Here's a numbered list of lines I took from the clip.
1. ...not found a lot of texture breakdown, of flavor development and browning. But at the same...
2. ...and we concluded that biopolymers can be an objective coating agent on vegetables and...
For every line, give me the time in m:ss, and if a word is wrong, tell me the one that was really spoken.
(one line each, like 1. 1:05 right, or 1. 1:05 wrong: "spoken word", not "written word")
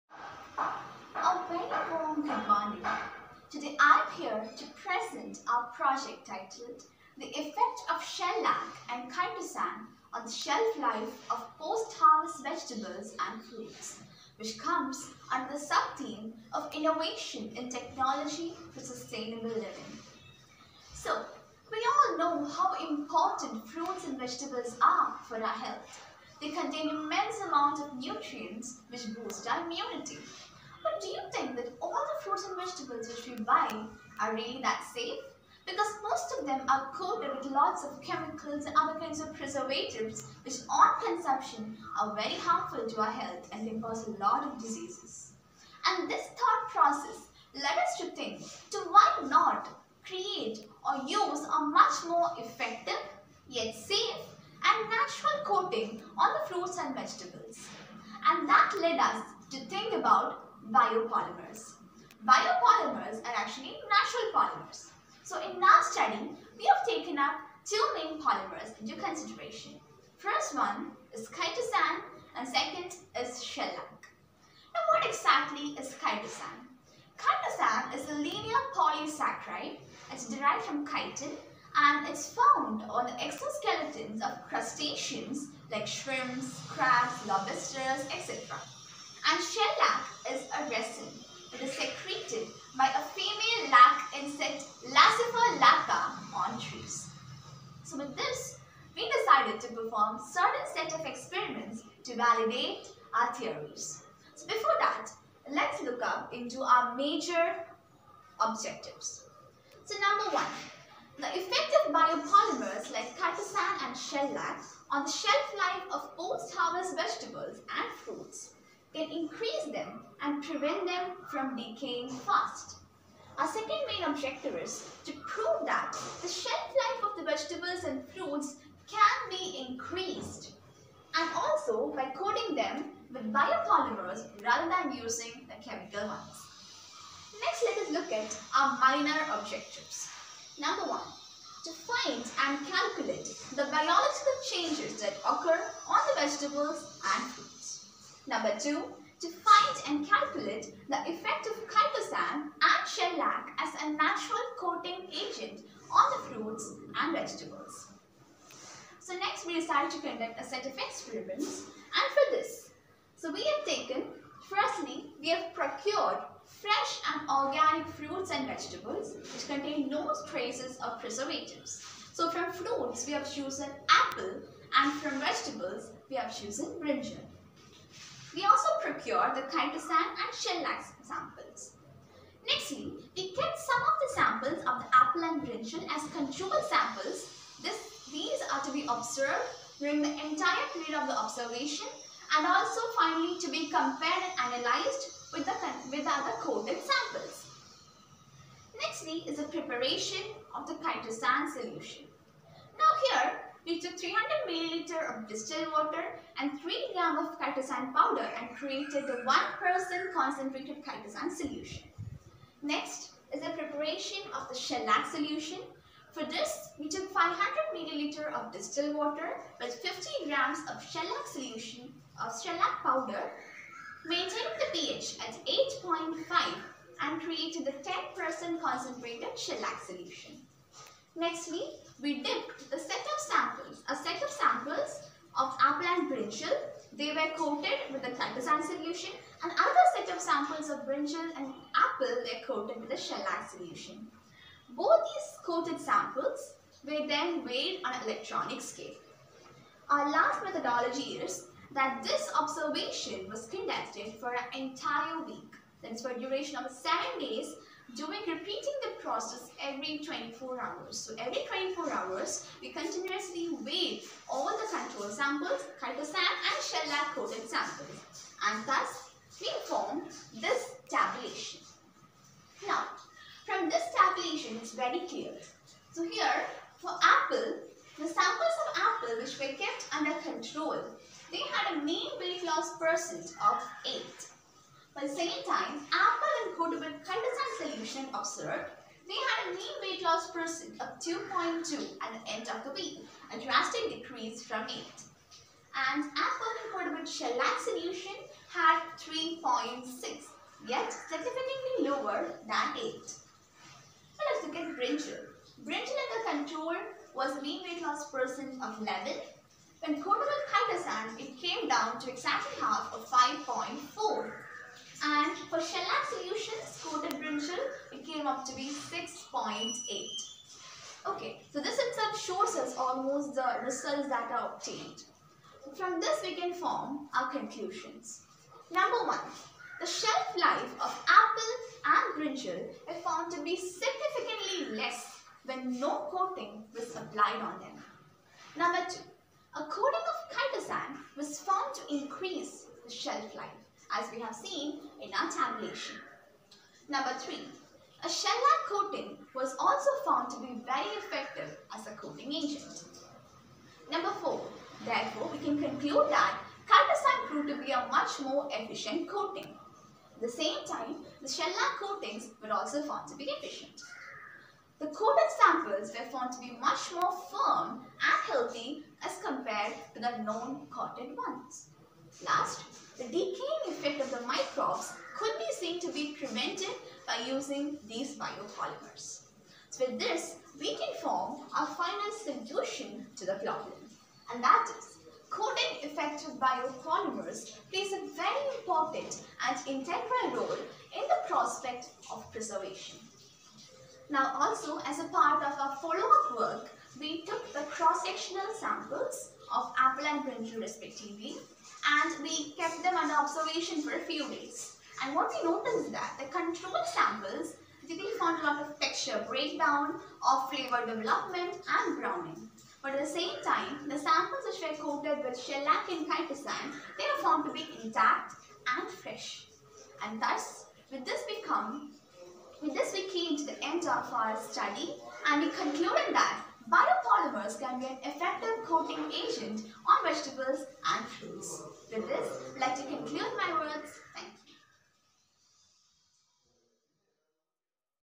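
1. 6:47 right
2. 7:05 wrong: "effective", not "objective".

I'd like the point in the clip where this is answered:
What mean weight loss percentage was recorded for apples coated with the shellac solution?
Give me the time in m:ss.
4:58.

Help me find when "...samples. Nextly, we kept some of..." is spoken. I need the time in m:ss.
3:01.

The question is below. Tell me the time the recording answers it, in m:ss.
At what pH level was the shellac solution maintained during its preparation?
3:45.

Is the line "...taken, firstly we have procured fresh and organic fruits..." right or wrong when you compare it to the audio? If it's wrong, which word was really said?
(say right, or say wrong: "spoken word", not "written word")
right.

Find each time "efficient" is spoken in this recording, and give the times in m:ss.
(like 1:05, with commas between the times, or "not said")
5:58, 6:03.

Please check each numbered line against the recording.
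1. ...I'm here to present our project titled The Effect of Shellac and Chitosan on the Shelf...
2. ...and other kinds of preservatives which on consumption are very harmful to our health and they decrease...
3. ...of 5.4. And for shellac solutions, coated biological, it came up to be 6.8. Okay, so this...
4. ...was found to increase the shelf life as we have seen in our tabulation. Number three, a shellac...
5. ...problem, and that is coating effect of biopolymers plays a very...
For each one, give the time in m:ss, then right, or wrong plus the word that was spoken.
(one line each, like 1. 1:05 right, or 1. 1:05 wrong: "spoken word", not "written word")
1. 0:03 right
2. 0:38 wrong: "cause", not "decrease"
3. 5:12 wrong: "brinjal", not "biological"
4. 5:41 right
5. 6:23 right.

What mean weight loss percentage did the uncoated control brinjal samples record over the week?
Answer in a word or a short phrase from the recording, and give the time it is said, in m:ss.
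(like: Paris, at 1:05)
11, at 5:08.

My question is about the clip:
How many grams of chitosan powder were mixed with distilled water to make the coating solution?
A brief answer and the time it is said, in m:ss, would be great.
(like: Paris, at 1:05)
3 grams, at 3:26.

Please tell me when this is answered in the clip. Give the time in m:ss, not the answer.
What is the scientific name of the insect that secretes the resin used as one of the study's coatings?
1:34.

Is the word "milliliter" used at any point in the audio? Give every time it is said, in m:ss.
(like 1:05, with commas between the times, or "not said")
3:24, 3:37.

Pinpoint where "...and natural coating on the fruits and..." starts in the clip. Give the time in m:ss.
0:54.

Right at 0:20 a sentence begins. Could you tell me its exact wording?
So, we all know how important fruits and vegetables are for our health.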